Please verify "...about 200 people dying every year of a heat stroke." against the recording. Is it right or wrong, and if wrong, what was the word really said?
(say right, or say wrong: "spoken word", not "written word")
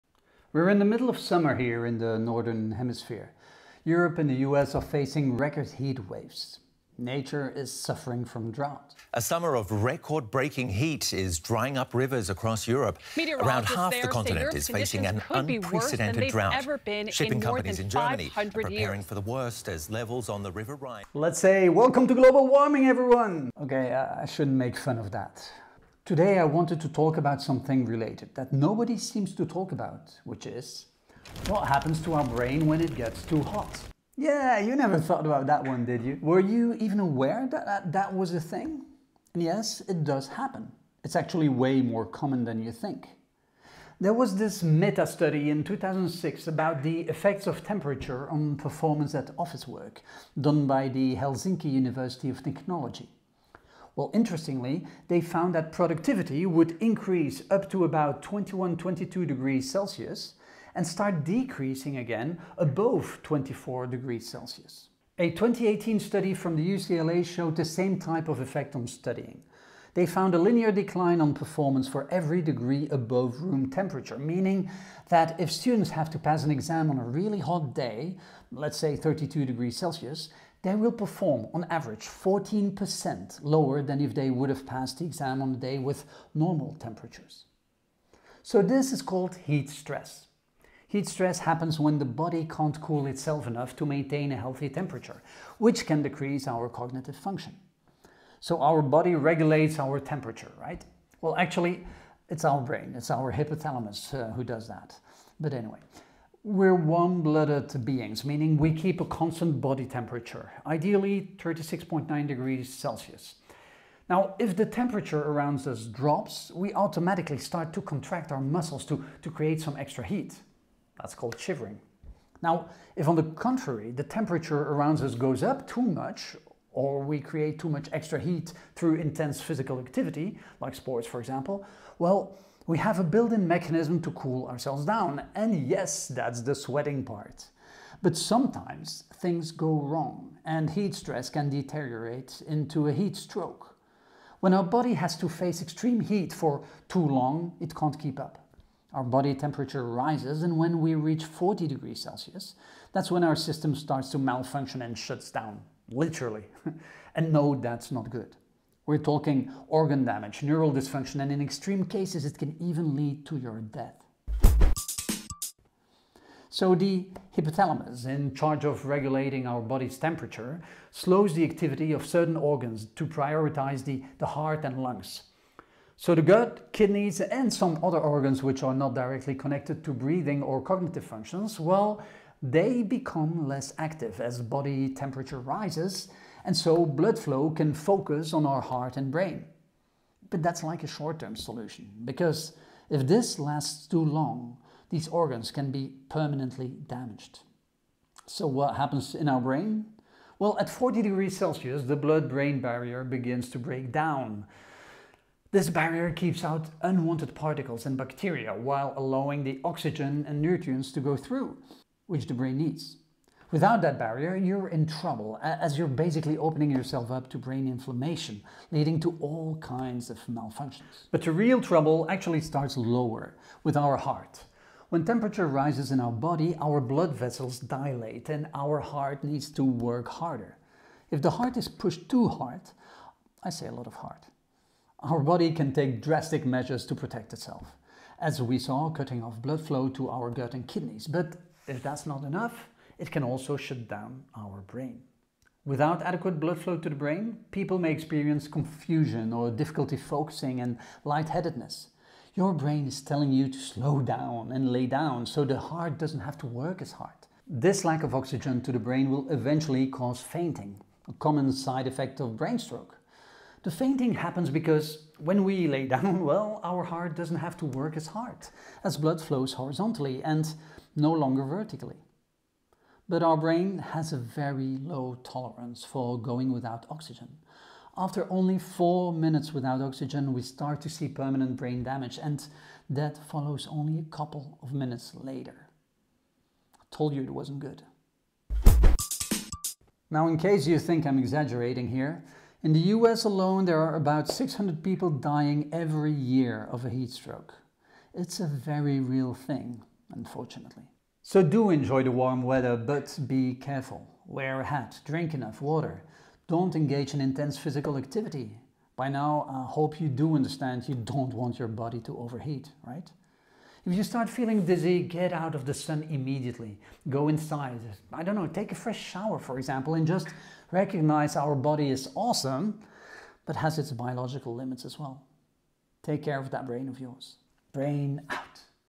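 wrong: "600", not "200".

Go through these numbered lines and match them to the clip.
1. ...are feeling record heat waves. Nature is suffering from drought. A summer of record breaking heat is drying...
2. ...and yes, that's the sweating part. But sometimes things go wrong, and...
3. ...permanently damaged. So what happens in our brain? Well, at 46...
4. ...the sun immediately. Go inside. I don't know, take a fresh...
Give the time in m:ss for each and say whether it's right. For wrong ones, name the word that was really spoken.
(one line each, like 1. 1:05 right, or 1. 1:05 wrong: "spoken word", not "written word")
1. 0:04 wrong: "facing", not "feeling"
2. 2:15 right
3. 3:16 wrong: "40", not "46"
4. 5:15 right.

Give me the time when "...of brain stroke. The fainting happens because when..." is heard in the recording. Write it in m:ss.
4:22.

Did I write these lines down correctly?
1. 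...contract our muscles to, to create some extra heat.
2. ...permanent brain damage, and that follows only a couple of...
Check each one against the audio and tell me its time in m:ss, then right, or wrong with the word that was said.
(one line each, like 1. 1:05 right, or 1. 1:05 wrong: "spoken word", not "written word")
1. 1:57 right
2. 4:41 right.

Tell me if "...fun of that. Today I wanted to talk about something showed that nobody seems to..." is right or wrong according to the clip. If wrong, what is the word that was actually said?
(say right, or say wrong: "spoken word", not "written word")
wrong: "related", not "showed".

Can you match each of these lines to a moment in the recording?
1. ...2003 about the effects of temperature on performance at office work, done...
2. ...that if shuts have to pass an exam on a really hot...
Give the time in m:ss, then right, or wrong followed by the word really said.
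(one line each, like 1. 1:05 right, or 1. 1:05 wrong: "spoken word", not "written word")
1. 0:45 wrong: "2006", not "2003"
2. 1:15 wrong: "students", not "shuts".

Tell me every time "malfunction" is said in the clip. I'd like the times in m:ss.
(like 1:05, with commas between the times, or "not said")
2:34, 3:40.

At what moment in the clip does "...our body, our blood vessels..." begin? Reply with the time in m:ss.
3:45.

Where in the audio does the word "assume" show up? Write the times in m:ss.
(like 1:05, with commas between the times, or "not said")
not said.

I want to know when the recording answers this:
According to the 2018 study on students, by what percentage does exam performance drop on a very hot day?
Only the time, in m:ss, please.
1:22.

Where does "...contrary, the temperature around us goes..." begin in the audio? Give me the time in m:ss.
2:03.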